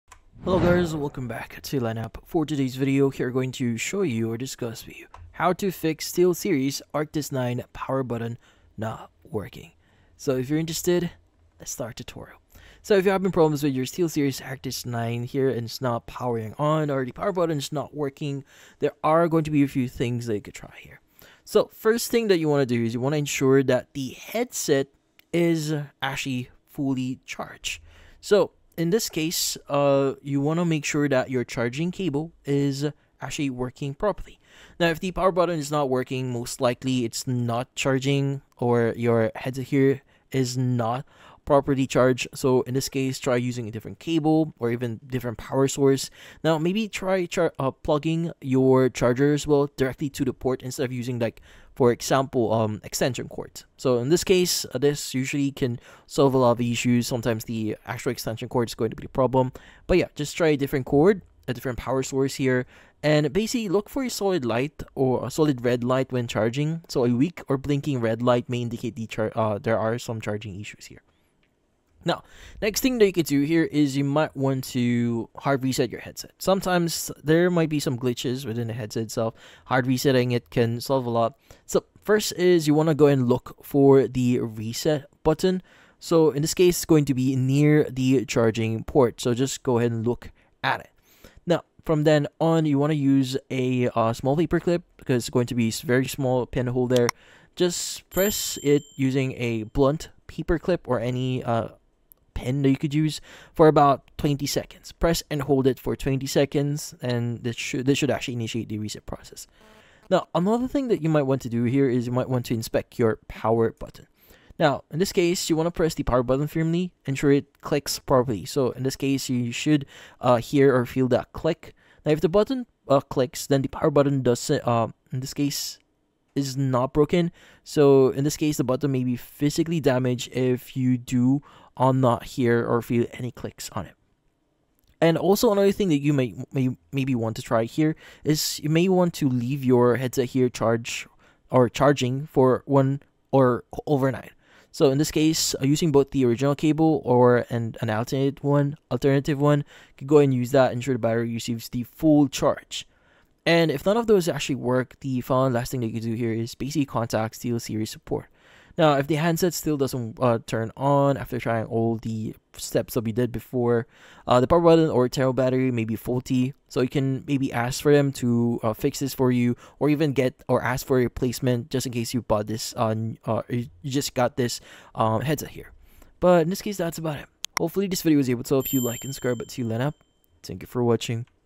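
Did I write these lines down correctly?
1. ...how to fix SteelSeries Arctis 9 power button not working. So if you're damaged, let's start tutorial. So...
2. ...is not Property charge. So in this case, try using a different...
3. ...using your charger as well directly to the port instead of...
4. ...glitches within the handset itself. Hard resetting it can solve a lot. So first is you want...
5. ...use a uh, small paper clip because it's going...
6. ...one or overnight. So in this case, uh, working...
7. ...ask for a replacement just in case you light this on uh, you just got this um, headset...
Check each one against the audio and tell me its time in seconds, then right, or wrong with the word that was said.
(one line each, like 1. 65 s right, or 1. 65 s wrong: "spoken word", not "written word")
1. 5 s wrong: "interested", not "damaged"
2. 40 s right
3. 47 s wrong: "plugging", not "using"
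4. 77 s wrong: "headset", not "handset"
5. 92 s right
6. 142 s wrong: "using", not "working"
7. 170 s wrong: "bought", not "light".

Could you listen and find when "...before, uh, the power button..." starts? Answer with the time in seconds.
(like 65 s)
163 s.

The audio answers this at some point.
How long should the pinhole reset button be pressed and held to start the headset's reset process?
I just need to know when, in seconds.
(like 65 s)
103 s.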